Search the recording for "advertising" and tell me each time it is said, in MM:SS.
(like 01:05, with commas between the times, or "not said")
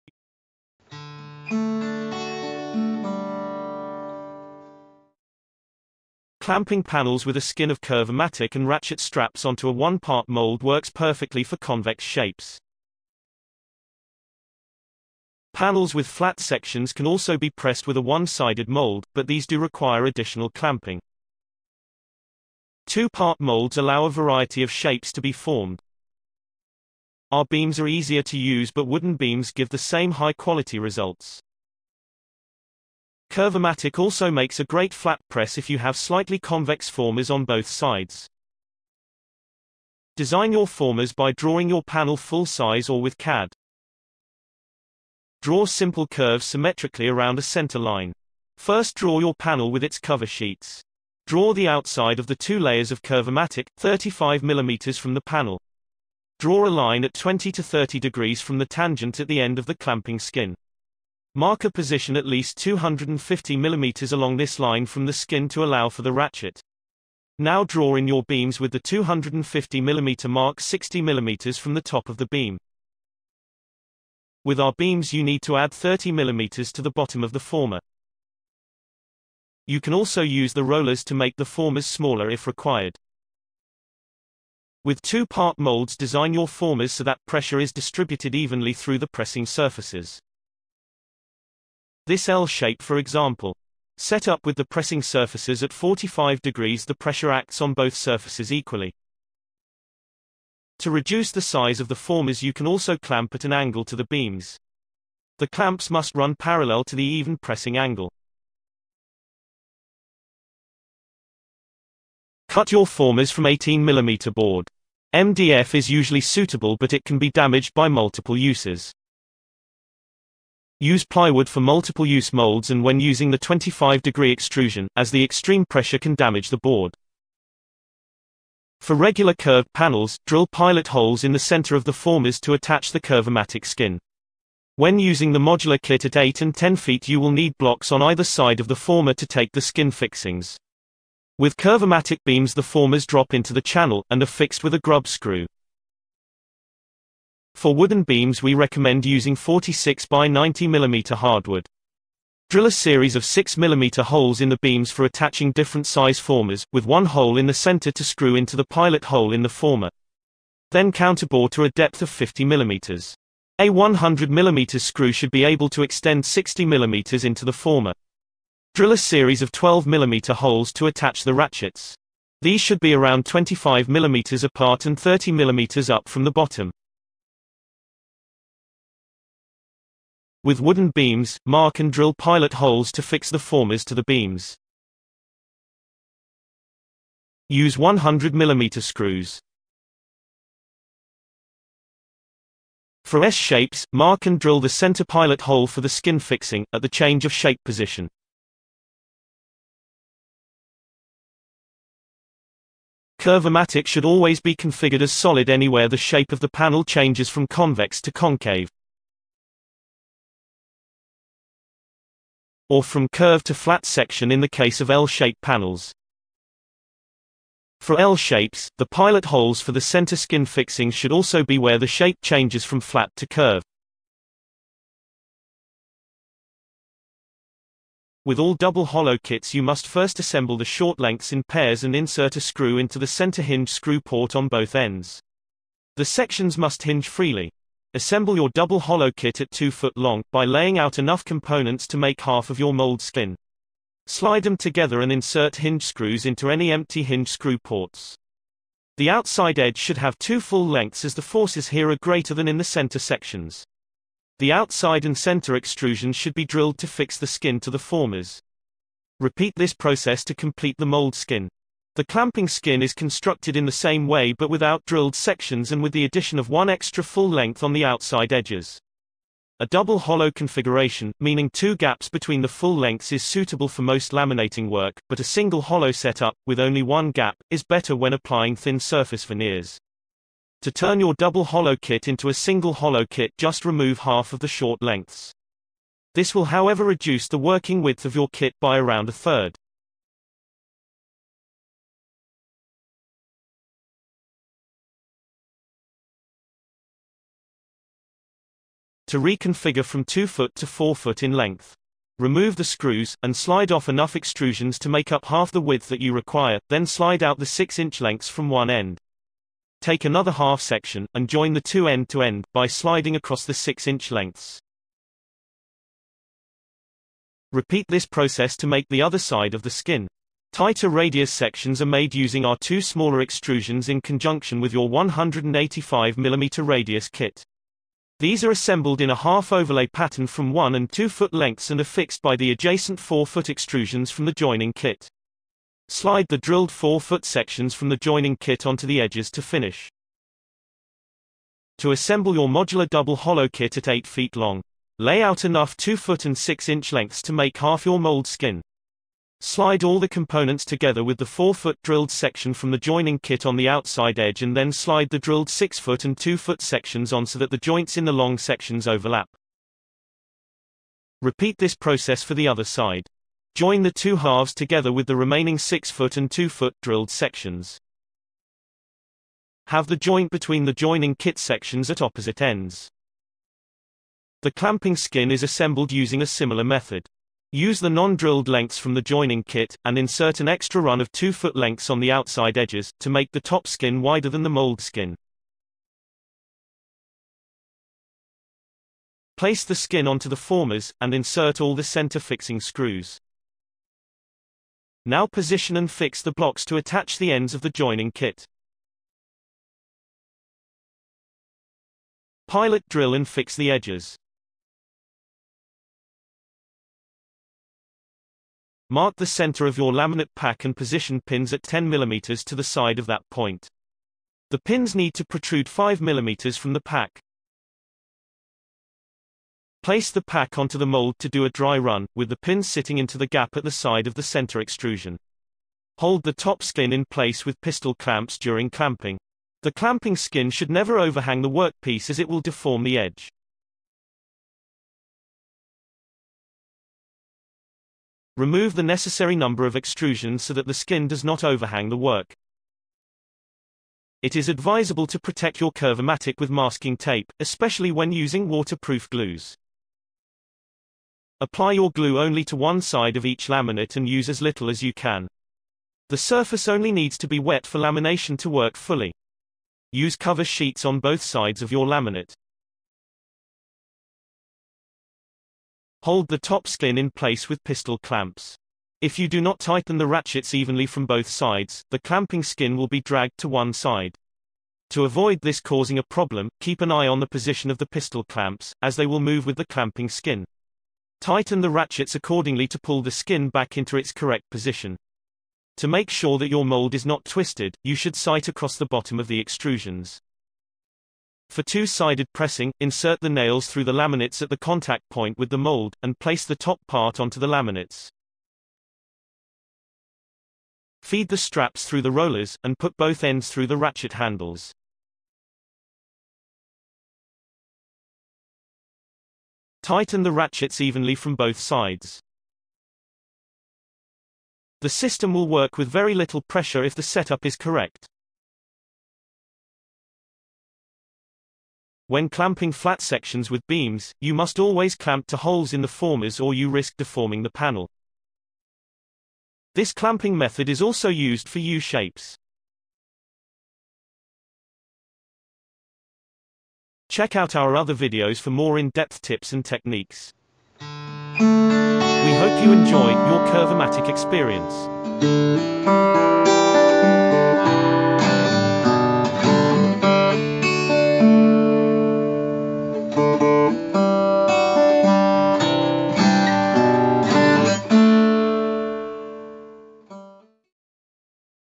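not said.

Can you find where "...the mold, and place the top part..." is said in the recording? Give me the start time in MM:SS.
08:15.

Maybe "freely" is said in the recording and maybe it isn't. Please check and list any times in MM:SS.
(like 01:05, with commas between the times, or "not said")
03:57.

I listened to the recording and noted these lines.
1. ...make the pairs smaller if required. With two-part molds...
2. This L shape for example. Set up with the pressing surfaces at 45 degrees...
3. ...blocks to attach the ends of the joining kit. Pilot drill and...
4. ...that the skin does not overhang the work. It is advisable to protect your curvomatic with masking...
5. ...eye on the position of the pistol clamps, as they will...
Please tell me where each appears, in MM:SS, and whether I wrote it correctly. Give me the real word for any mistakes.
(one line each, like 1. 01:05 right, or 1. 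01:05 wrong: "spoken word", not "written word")
1. 01:21 wrong: "formers", not "pairs"
2. 01:32 right
3. 06:36 right
4. 07:20 right
5. 07:56 right.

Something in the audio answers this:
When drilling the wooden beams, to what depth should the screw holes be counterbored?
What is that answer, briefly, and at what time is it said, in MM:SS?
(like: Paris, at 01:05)
50 mm, at 02:42.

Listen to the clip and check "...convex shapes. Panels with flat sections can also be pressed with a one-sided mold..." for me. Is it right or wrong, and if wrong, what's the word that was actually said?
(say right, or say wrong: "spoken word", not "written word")
right.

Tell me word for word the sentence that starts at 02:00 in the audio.
Use plywood for multiple-use molds and when using the 25-degree extrusion, as the extreme pressure can damage the board.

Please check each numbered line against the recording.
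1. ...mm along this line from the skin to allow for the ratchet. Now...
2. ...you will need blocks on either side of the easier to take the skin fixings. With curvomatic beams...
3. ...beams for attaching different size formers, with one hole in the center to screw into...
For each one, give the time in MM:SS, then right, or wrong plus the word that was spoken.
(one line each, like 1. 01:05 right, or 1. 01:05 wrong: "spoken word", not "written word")
1. 01:03 right
2. 02:17 wrong: "former", not "easier"
3. 02:34 right.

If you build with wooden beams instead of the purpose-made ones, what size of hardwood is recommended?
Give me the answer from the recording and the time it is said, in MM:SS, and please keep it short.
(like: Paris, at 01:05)
46 by 90 mm, at 02:29.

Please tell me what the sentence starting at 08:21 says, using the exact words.
Feed the straps through the rollers, and put both ends through the ratchet handles.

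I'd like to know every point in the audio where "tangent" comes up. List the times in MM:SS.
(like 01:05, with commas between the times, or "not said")
00:58.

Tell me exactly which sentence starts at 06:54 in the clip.
The pins need to protrude 5 mm from the pack.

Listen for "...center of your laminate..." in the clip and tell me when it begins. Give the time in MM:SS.
06:49.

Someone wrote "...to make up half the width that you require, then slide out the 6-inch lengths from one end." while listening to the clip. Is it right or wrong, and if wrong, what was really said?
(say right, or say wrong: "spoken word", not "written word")
right.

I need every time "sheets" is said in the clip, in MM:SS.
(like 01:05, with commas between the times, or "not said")
00:50, 07:40.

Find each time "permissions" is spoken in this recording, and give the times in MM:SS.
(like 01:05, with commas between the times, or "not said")
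not said.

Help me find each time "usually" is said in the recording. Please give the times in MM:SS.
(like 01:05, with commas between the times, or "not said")
01:55.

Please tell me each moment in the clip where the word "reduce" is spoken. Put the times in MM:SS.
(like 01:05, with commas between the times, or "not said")
01:40, 04:46.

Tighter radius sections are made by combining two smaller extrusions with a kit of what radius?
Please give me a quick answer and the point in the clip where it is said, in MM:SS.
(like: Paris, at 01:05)
185 mm, at 05:24.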